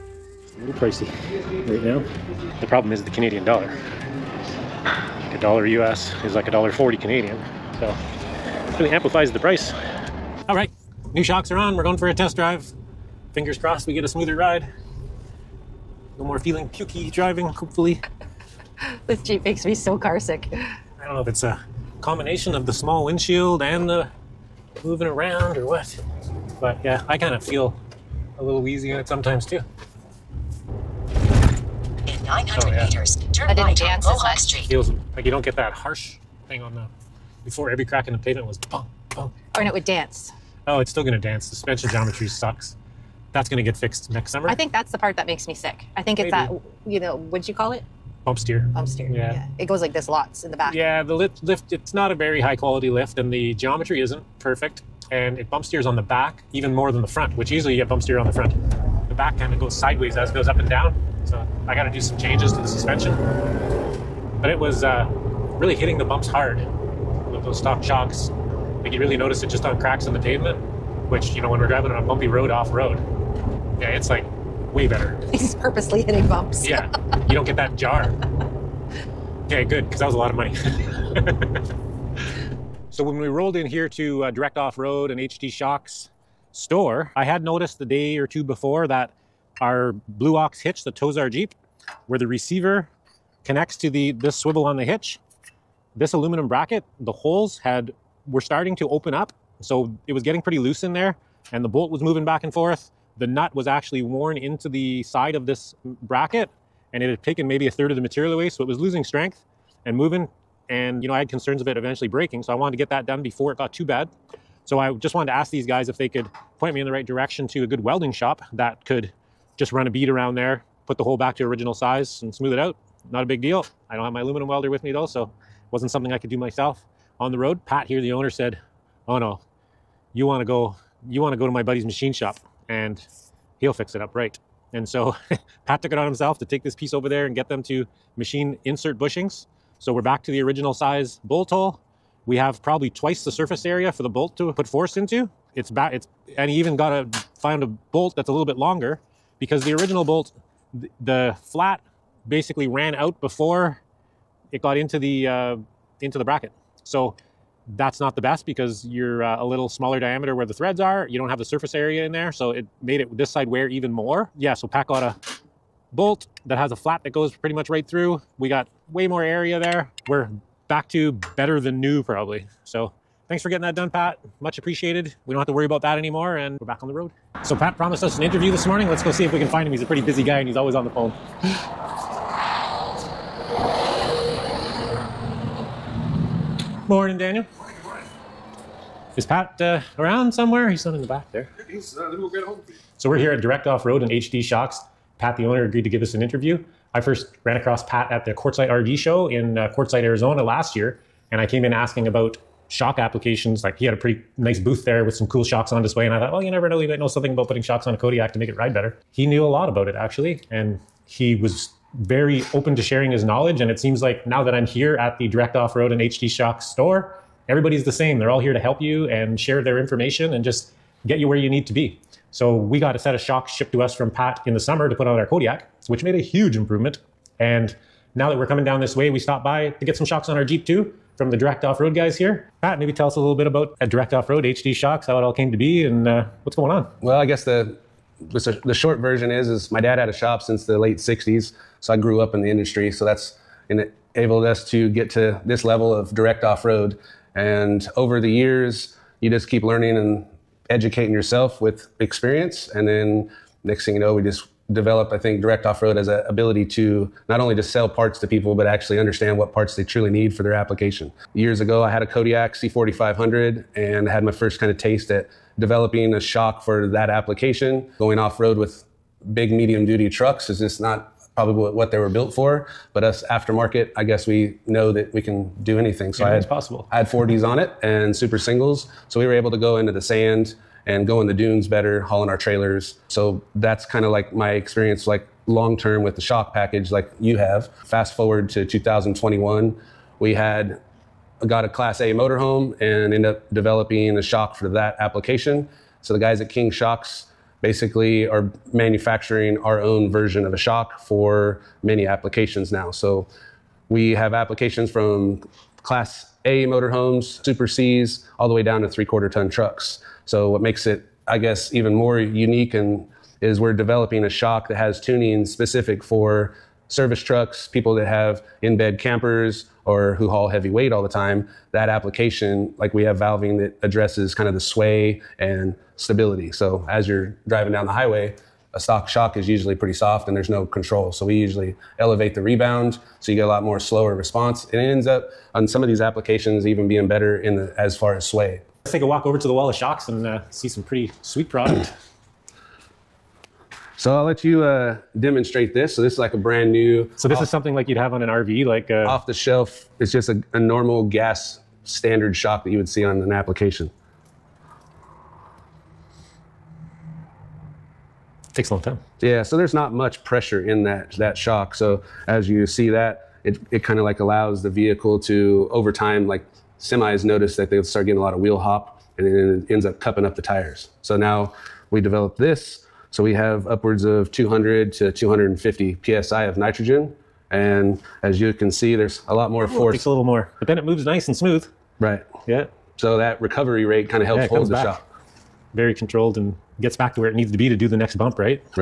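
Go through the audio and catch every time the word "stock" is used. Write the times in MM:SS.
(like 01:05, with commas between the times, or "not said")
01:07, 05:28.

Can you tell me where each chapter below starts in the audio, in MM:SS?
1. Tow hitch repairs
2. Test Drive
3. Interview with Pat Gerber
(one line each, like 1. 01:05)
1. 01:22
2. 00:10
3. 02:57.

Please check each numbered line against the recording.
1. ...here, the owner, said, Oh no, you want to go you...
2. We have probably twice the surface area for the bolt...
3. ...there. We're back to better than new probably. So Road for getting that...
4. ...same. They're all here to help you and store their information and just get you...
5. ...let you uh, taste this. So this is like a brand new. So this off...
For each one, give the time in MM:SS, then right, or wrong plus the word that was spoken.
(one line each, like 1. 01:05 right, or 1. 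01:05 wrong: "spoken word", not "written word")
1. 02:07 right
2. 02:22 right
3. 02:49 wrong: "Thanks", not "Road"
4. 03:37 wrong: "share", not "store"
5. 05:44 wrong: "demonstrate", not "taste".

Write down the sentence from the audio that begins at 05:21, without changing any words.
That application, like we have valving that addresses kind of the sway and stability.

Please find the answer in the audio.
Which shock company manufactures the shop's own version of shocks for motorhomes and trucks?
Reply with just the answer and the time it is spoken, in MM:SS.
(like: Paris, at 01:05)
King Shocks, at 04:56.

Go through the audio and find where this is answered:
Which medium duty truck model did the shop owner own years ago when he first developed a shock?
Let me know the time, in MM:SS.
04:22.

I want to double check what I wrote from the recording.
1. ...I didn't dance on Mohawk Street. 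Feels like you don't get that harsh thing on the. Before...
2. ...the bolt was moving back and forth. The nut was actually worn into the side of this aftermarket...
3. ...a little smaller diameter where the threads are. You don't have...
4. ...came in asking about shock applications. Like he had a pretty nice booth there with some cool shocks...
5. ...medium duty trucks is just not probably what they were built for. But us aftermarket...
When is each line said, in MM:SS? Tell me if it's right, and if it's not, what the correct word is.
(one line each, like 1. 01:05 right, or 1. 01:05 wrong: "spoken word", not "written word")
1. 00:33 right
2. 01:41 wrong: "bracket", not "aftermarket"
3. 02:39 right
4. 03:21 right
5. 04:29 right.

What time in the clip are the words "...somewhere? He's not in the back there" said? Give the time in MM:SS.
03:10.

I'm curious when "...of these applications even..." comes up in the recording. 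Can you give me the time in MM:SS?
05:35.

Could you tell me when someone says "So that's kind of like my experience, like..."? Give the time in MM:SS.
04:43.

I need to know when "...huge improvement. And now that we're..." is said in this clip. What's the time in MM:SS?
03:46.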